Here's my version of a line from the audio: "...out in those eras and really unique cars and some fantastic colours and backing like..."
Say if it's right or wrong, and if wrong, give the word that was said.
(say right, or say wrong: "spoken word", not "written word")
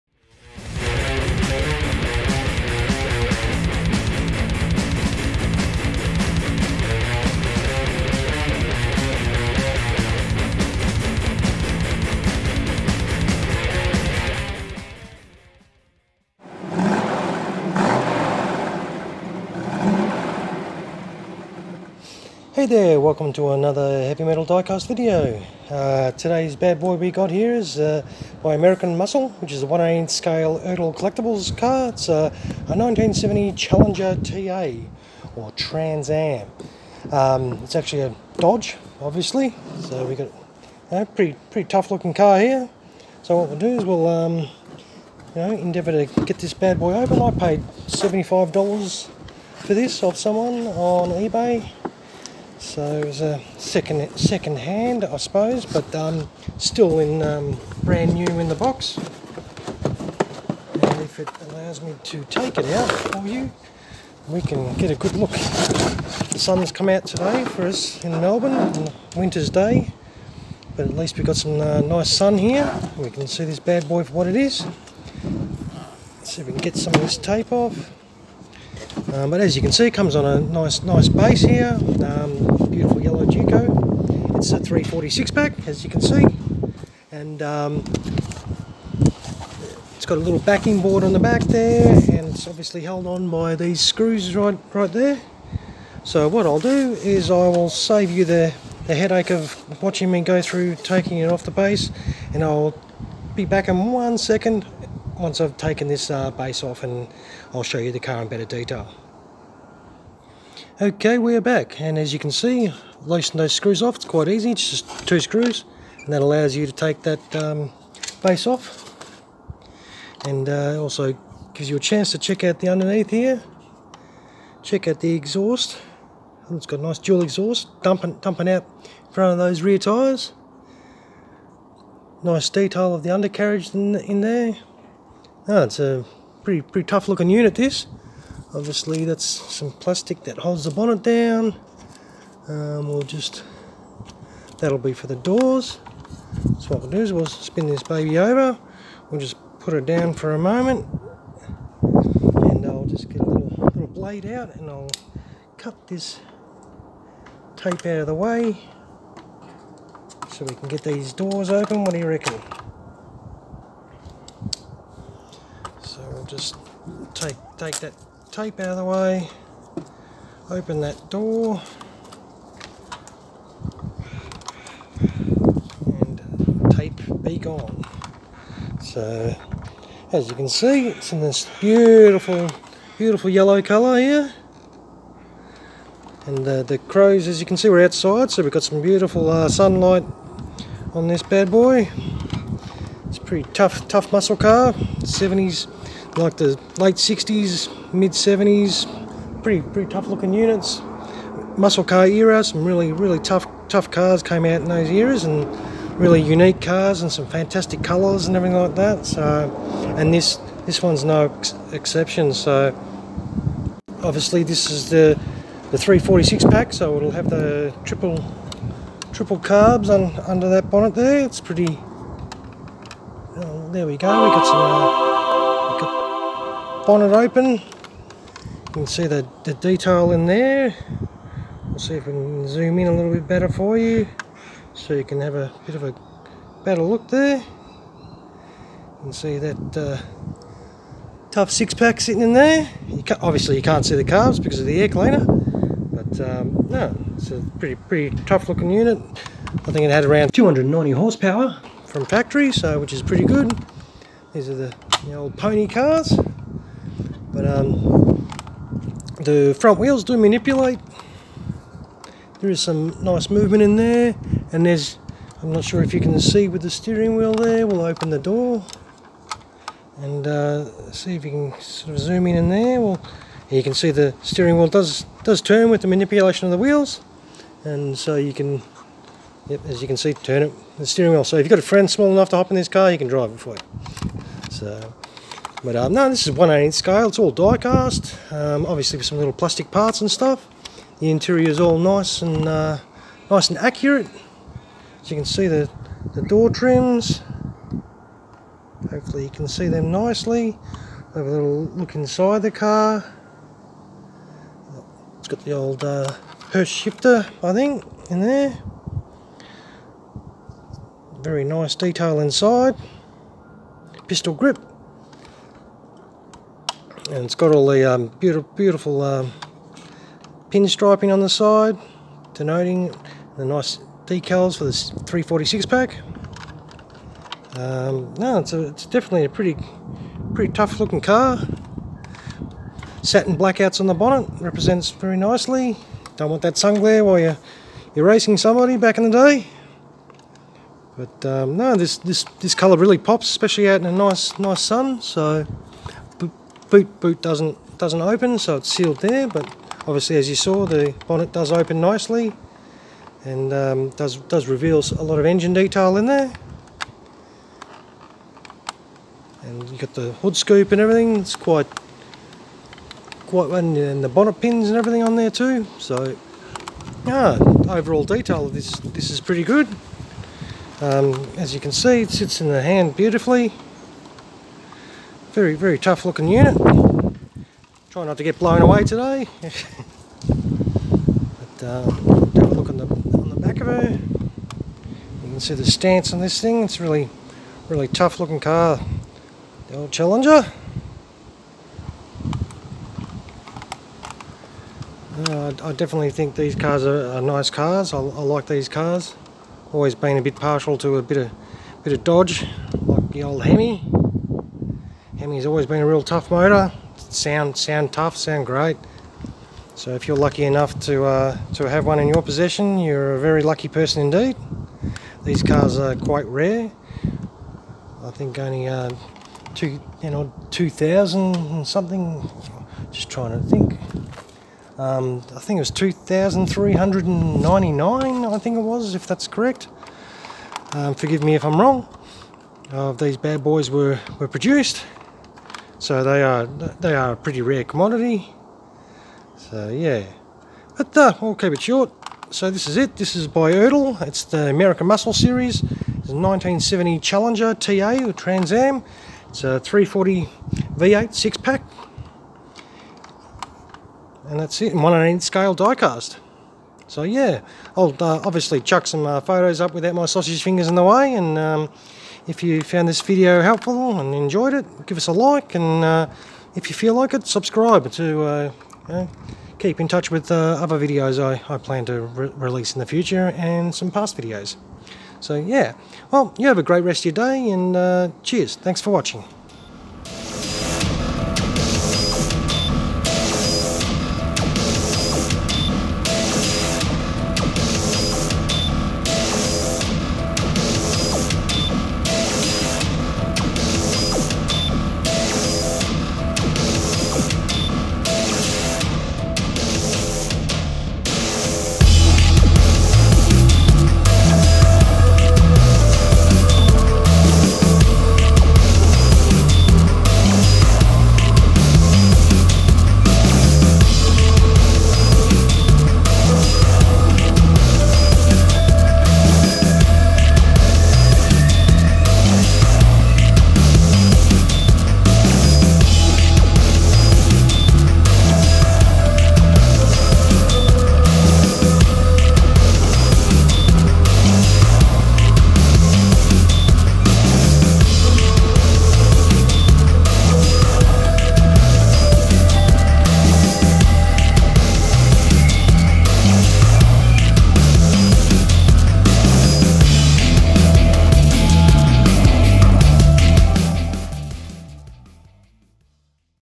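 wrong: "everything", not "backing".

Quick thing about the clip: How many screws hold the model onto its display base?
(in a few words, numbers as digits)
2.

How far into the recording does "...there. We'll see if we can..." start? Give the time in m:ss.
3:50.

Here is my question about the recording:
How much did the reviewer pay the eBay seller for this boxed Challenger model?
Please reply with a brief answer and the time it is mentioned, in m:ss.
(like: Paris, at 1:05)
$75, at 0:47.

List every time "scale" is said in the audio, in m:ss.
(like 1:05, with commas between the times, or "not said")
0:30, 4:46, 7:35.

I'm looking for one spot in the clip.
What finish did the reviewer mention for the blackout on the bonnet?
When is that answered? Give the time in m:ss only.
5:33.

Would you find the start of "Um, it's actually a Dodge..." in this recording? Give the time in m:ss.
0:37.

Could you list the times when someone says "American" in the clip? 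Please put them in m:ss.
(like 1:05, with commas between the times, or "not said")
0:28, 7:24.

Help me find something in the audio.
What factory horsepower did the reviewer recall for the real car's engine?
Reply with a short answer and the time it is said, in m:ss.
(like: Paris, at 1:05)
290, at 4:10.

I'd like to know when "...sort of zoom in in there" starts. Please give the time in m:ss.
4:31.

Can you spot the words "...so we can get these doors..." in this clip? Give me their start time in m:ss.
2:40.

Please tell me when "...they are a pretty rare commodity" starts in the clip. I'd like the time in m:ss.
7:16.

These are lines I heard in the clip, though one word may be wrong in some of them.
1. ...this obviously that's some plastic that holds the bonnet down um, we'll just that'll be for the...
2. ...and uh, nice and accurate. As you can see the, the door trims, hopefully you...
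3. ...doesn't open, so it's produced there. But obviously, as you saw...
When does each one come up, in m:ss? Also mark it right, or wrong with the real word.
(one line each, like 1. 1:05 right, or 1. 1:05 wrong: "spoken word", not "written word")
1. 2:17 right
2. 4:52 right
3. 5:47 wrong: "sealed", not "produced".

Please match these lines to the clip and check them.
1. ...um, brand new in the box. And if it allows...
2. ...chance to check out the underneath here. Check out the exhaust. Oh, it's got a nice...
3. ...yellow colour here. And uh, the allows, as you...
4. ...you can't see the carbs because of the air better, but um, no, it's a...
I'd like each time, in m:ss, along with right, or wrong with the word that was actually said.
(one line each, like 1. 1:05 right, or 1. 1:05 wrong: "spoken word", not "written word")
1. 0:57 right
2. 2:01 right
3. 3:03 wrong: "crows", not "allows"
4. 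4:03 wrong: "cleaner", not "better".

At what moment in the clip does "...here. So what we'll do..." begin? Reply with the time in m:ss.
0:42.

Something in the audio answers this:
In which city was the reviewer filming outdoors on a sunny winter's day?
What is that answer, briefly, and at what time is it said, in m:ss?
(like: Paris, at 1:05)
Melbourne, at 1:08.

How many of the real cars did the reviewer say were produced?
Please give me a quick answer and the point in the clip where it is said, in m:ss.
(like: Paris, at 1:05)
2,399, at 7:05.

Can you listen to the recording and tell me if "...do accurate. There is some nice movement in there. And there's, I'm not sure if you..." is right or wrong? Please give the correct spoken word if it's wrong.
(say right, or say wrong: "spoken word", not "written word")
wrong: "manipulate", not "accurate".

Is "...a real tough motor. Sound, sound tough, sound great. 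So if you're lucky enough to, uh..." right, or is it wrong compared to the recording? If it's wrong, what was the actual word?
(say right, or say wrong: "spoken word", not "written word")
right.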